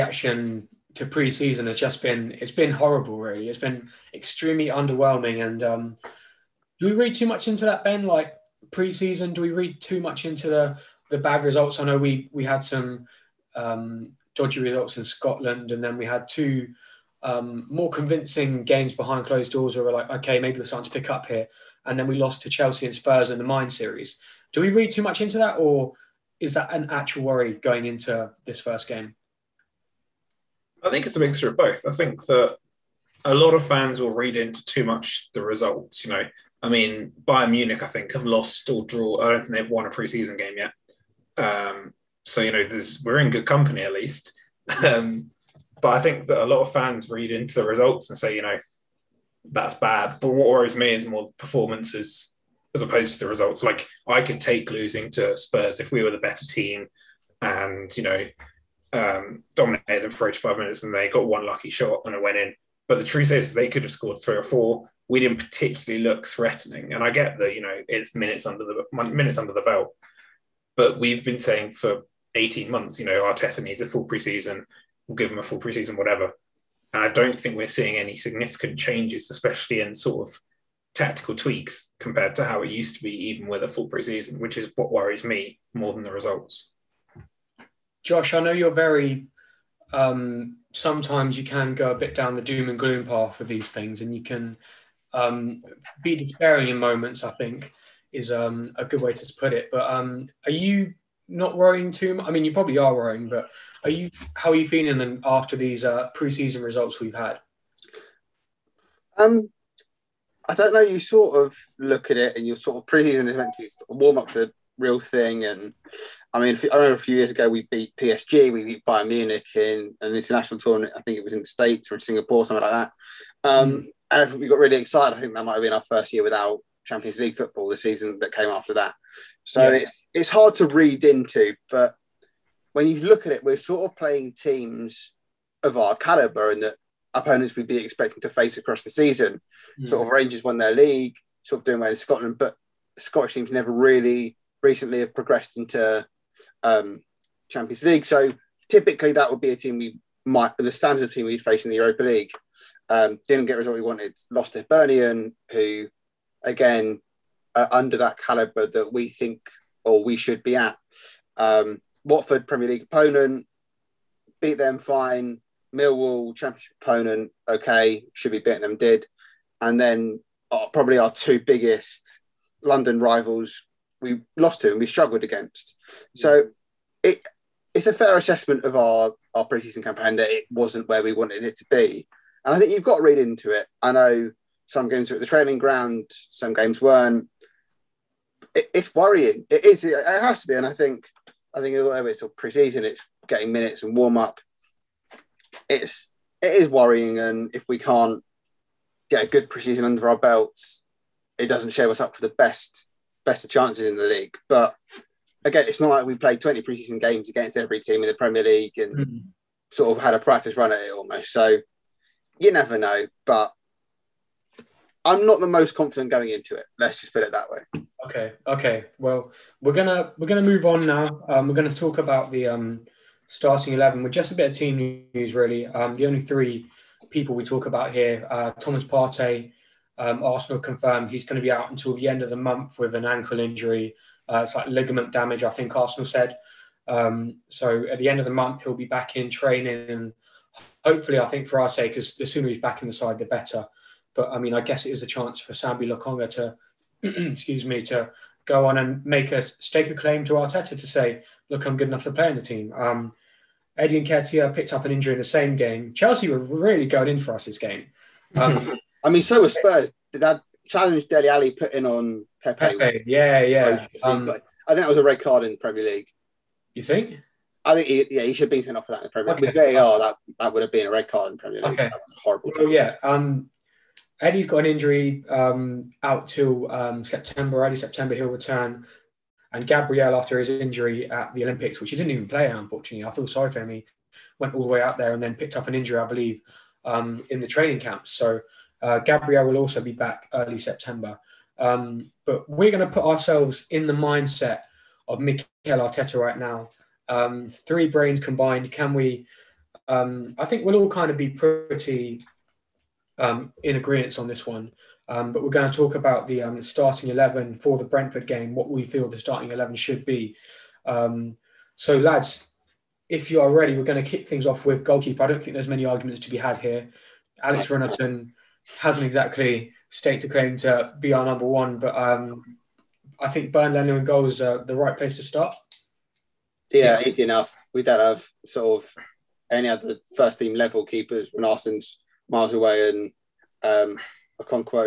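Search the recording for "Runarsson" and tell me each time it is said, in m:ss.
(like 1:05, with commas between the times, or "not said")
5:17, 5:31.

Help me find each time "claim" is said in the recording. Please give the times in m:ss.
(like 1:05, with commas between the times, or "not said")
4:09, 5:20.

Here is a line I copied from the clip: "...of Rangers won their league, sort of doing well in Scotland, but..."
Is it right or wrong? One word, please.
right.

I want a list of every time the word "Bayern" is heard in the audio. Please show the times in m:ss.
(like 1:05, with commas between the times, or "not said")
0:37, 1:58.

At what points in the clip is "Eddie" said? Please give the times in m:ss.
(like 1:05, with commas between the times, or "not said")
4:13, 4:34.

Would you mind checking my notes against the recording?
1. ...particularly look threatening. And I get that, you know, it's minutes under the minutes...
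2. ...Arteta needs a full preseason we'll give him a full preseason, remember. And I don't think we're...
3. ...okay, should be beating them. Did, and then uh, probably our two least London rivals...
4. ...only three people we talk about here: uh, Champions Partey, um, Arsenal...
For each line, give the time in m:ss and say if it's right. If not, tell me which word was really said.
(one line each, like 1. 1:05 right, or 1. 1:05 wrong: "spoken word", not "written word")
1. 1:05 right
2. 1:13 wrong: "whatever", not "remember"
3. 2:47 wrong: "biggest", not "least"
4. 3:46 wrong: "Thomas", not "Champions".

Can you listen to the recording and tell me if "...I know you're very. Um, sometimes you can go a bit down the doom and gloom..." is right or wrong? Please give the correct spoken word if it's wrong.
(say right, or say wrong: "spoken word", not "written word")
right.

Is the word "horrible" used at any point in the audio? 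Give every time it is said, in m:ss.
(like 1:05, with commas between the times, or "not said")
0:02, 4:32.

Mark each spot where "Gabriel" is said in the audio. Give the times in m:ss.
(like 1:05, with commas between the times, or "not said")
4:39, 4:48.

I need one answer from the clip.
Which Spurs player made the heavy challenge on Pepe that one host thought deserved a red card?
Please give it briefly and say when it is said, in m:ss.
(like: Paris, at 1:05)
Dele Alli, at 4:21.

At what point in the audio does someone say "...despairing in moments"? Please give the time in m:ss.
1:36.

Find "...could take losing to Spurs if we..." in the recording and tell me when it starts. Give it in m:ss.
0:54.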